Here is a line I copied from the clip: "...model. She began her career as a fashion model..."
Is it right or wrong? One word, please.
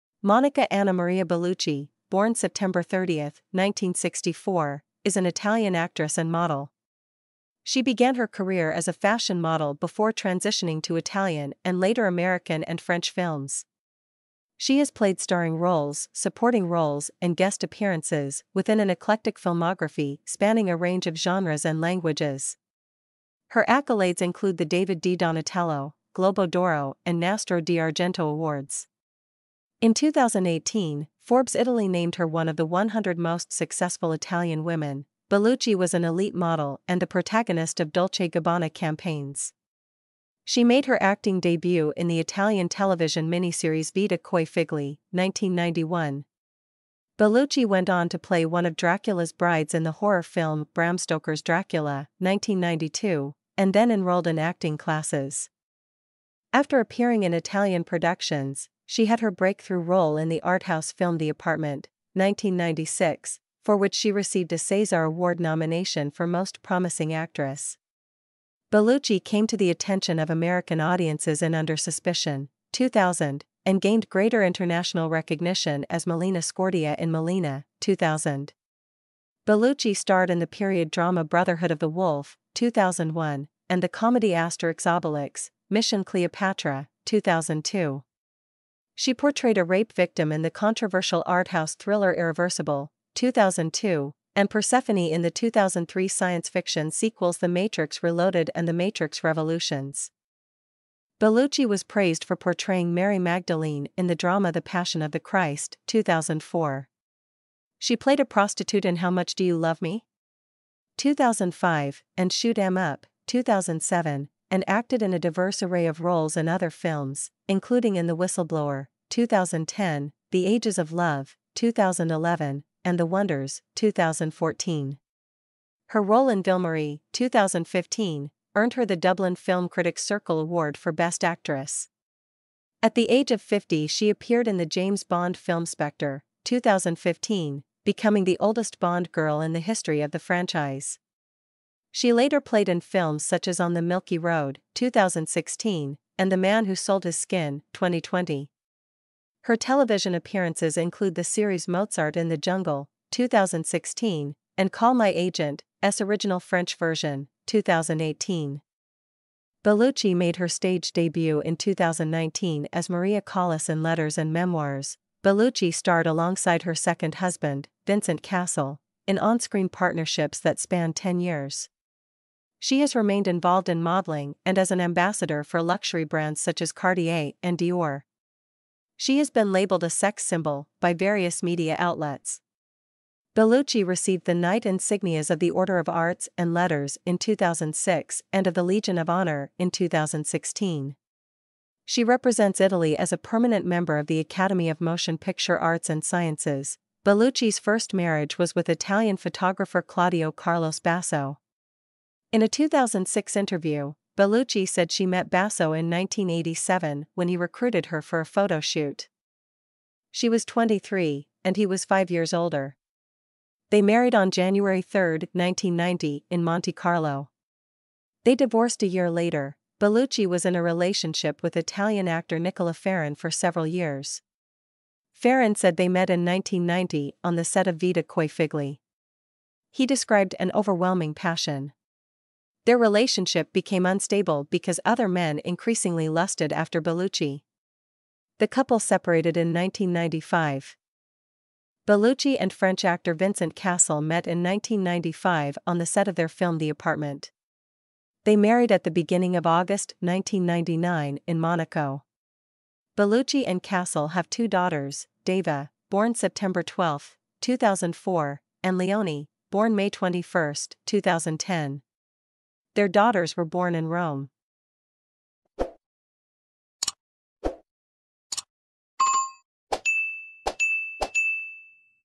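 right.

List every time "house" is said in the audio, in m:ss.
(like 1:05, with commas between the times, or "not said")
1:00, 1:31.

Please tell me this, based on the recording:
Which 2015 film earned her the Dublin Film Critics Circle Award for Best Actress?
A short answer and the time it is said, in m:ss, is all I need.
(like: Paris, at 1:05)
Ville-Marie, at 2:06.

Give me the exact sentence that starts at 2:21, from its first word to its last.
She later played in films such as On the Milky Road, 2016, and The Man Who Sold His Skin, 2020.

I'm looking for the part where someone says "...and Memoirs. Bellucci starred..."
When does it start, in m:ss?
2:44.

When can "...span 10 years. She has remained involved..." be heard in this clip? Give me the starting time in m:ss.
2:50.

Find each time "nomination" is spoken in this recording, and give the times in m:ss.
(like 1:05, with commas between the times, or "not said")
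1:05.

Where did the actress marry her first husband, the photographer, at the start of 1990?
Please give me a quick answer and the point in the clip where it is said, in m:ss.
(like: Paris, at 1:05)
Monte Carlo, at 3:36.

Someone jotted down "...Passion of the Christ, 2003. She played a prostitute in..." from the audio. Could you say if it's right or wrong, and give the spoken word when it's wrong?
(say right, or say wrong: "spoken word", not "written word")
wrong: "2004", not "2003".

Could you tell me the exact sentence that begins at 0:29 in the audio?
In 2018, Forbes Italy named her one of the 100 most successful Italian women.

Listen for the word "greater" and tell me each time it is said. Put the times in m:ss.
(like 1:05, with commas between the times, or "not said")
1:14.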